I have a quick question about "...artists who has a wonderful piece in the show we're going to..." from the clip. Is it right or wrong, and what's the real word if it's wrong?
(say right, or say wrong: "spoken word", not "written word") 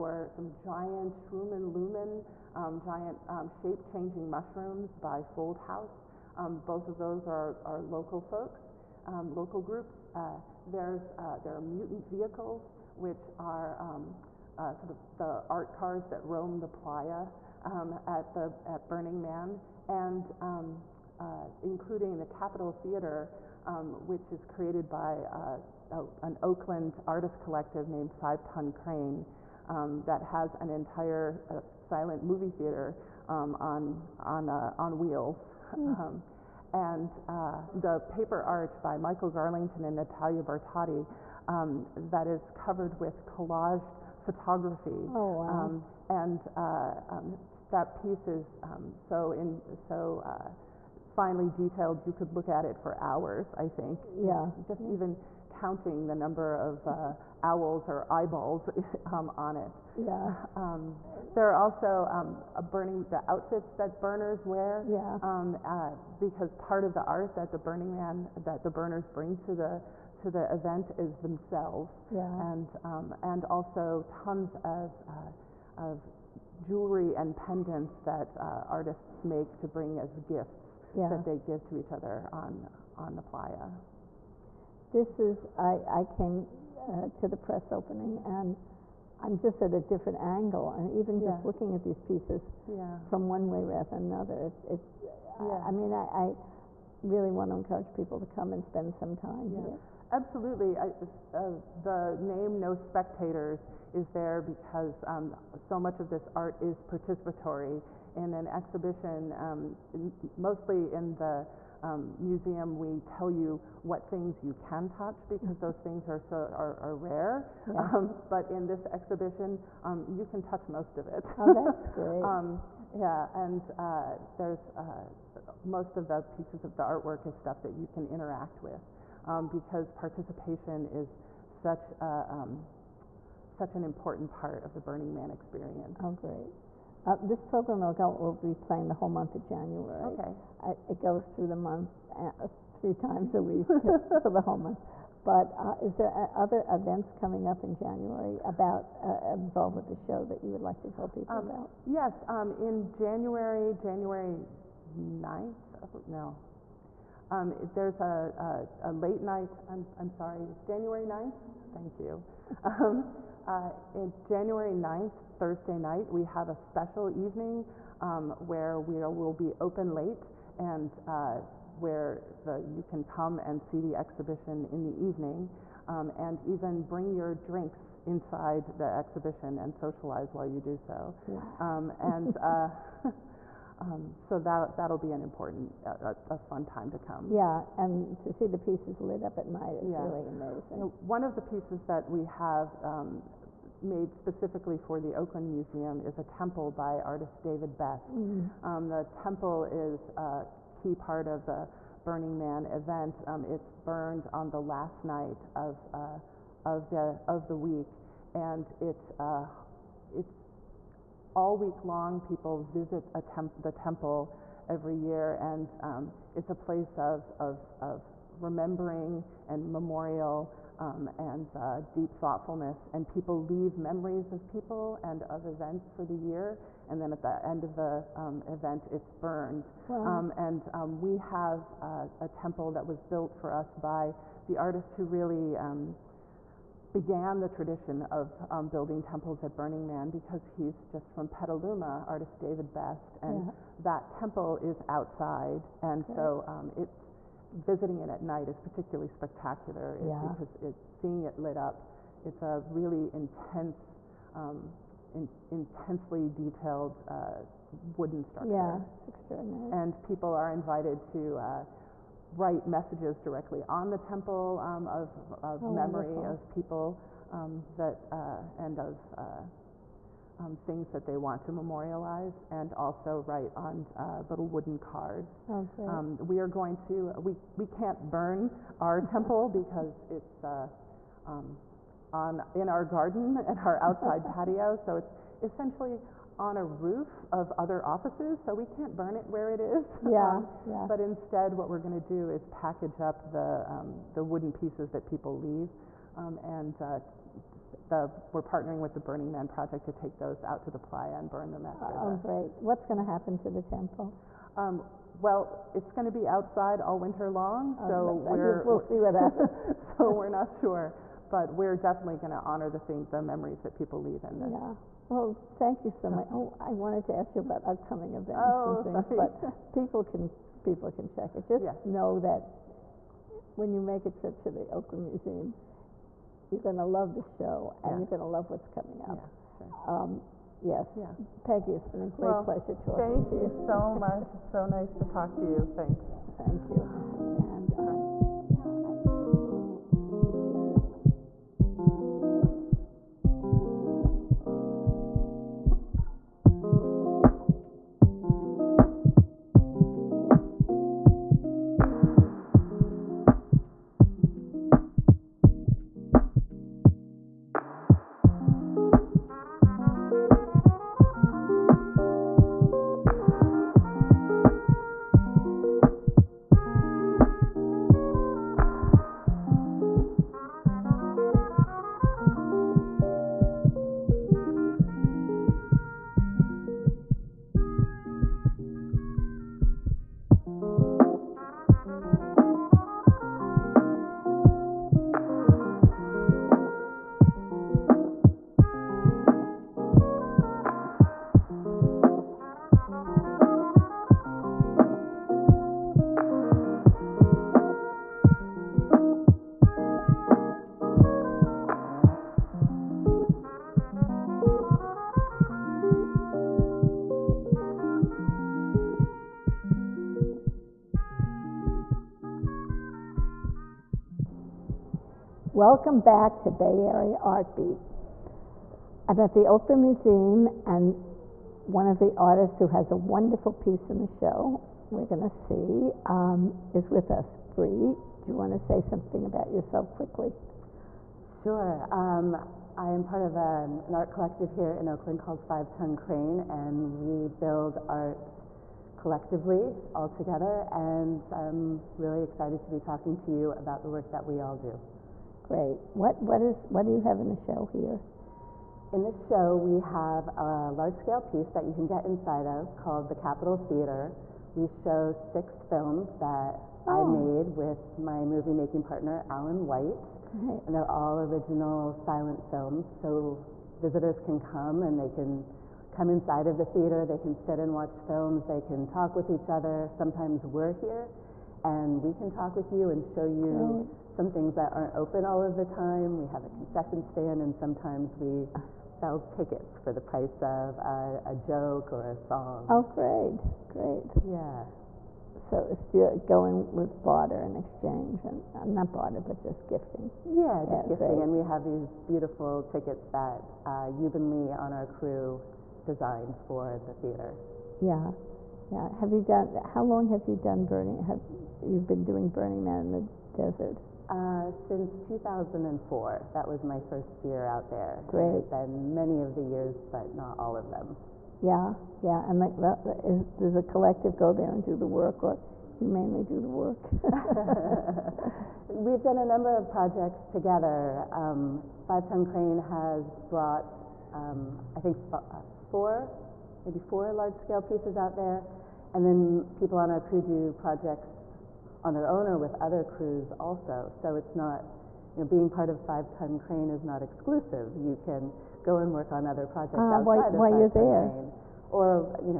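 right.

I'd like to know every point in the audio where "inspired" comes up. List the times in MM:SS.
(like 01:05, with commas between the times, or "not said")
not said.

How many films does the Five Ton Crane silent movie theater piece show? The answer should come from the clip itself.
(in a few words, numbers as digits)
6.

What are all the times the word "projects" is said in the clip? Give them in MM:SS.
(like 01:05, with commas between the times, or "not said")
04:59, 08:39, 08:50, 08:59.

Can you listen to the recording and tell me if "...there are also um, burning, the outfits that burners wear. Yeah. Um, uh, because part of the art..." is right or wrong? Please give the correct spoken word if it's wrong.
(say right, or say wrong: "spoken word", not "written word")
right.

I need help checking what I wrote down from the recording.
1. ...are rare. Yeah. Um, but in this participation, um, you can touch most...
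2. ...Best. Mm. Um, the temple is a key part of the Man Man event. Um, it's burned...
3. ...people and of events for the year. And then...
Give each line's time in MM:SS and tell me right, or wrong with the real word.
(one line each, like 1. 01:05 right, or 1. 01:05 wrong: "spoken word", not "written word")
1. 01:56 wrong: "exhibition", not "participation"
2. 03:17 wrong: "Burning", not "Man"
3. 03:44 right.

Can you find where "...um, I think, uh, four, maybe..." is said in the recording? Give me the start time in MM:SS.
08:44.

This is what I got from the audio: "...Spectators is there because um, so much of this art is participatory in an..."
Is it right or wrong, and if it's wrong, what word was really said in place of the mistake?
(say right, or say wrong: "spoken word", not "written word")
right.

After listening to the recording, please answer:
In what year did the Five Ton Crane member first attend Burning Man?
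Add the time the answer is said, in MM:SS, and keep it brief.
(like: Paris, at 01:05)
2004, at 08:24.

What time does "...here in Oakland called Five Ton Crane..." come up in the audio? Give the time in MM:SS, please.
07:14.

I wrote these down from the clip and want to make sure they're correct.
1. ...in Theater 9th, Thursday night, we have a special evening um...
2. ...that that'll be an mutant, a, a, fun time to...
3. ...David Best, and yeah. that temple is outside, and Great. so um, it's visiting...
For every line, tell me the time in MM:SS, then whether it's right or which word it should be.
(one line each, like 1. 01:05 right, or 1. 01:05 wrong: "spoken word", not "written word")
1. 02:43 wrong: "January", not "Theater"
2. 03:04 wrong: "important", not "mutant"
3. 04:02 right.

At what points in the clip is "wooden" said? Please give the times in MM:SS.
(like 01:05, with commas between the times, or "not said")
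04:17, 04:34, 04:54.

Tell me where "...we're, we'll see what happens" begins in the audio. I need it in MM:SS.
05:08.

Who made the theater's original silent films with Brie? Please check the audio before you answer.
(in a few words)
Alan White.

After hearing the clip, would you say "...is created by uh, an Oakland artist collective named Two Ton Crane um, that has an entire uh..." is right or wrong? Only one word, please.
wrong.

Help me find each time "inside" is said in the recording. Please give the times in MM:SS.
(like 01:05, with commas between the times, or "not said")
02:58, 07:32, 07:46.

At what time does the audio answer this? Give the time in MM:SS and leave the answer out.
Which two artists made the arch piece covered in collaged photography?
00:38.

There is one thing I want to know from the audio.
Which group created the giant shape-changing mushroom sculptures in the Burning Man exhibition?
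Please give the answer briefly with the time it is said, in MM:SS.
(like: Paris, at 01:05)
FoldHaus, at 00:05.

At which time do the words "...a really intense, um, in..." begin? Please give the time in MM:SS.
04:12.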